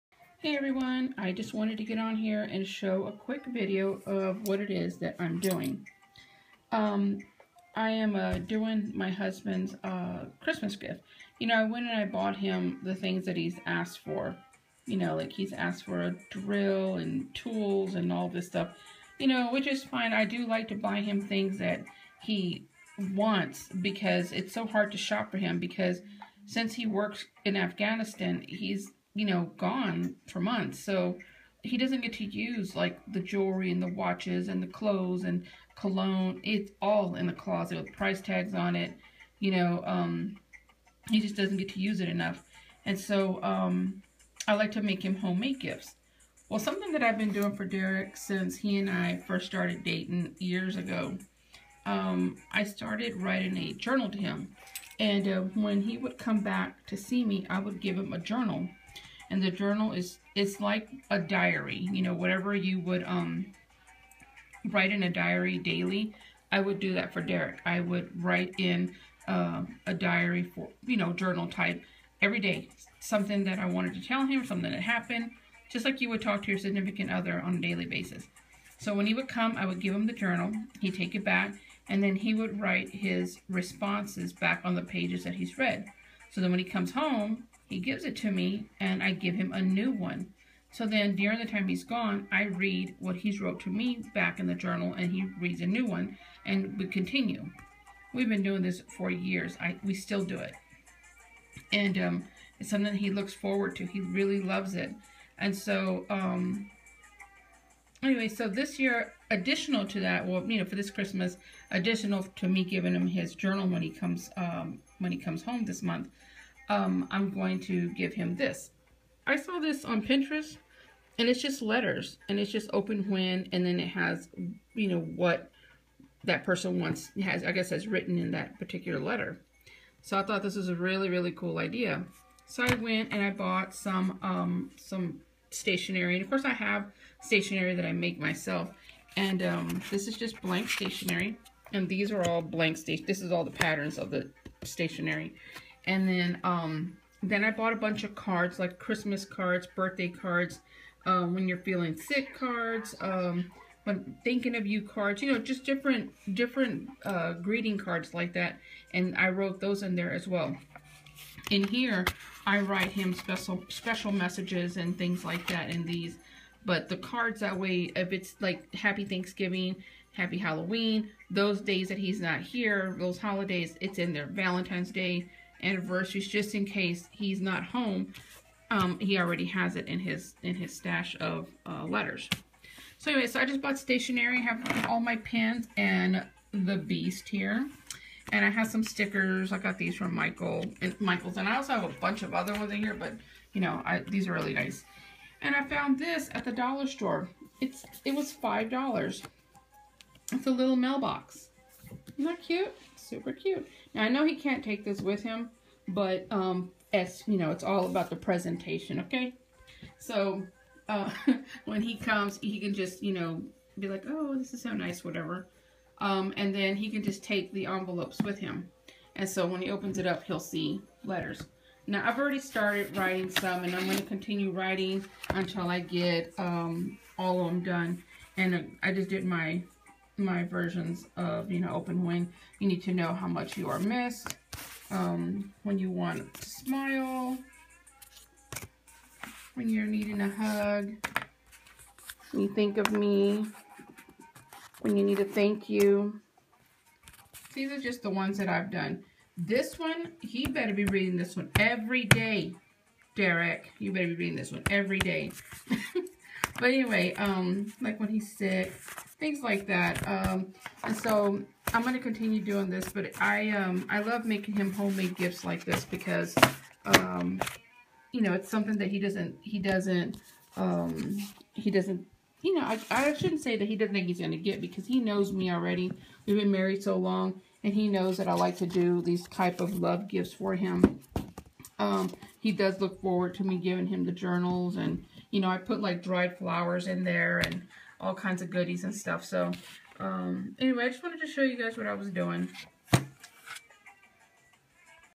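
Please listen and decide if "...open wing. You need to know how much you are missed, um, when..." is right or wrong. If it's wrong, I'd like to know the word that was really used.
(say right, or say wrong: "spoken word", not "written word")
right.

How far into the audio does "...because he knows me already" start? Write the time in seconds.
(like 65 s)
274 s.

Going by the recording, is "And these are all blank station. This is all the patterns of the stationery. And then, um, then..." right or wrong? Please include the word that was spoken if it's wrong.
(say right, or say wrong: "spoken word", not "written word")
right.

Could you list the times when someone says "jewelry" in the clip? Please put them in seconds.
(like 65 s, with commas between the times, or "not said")
33 s.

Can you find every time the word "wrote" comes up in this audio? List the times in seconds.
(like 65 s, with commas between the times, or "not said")
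93 s, 159 s.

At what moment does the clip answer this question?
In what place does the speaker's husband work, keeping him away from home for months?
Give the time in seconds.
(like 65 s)
27 s.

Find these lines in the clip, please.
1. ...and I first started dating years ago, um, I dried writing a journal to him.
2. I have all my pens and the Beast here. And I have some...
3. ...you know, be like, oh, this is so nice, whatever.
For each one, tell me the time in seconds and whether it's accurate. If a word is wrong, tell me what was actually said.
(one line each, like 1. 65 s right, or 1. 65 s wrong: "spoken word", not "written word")
1. 48 s wrong: "started", not "dried"
2. 184 s right
3. 213 s right.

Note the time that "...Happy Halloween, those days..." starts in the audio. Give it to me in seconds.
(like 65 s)
170 s.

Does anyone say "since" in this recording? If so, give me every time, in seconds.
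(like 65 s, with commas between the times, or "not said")
26 s, 48 s.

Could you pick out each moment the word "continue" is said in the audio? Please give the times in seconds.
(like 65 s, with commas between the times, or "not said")
96 s, 224 s, 261 s.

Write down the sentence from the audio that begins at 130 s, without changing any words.
So I thought this was a really, really cool idea.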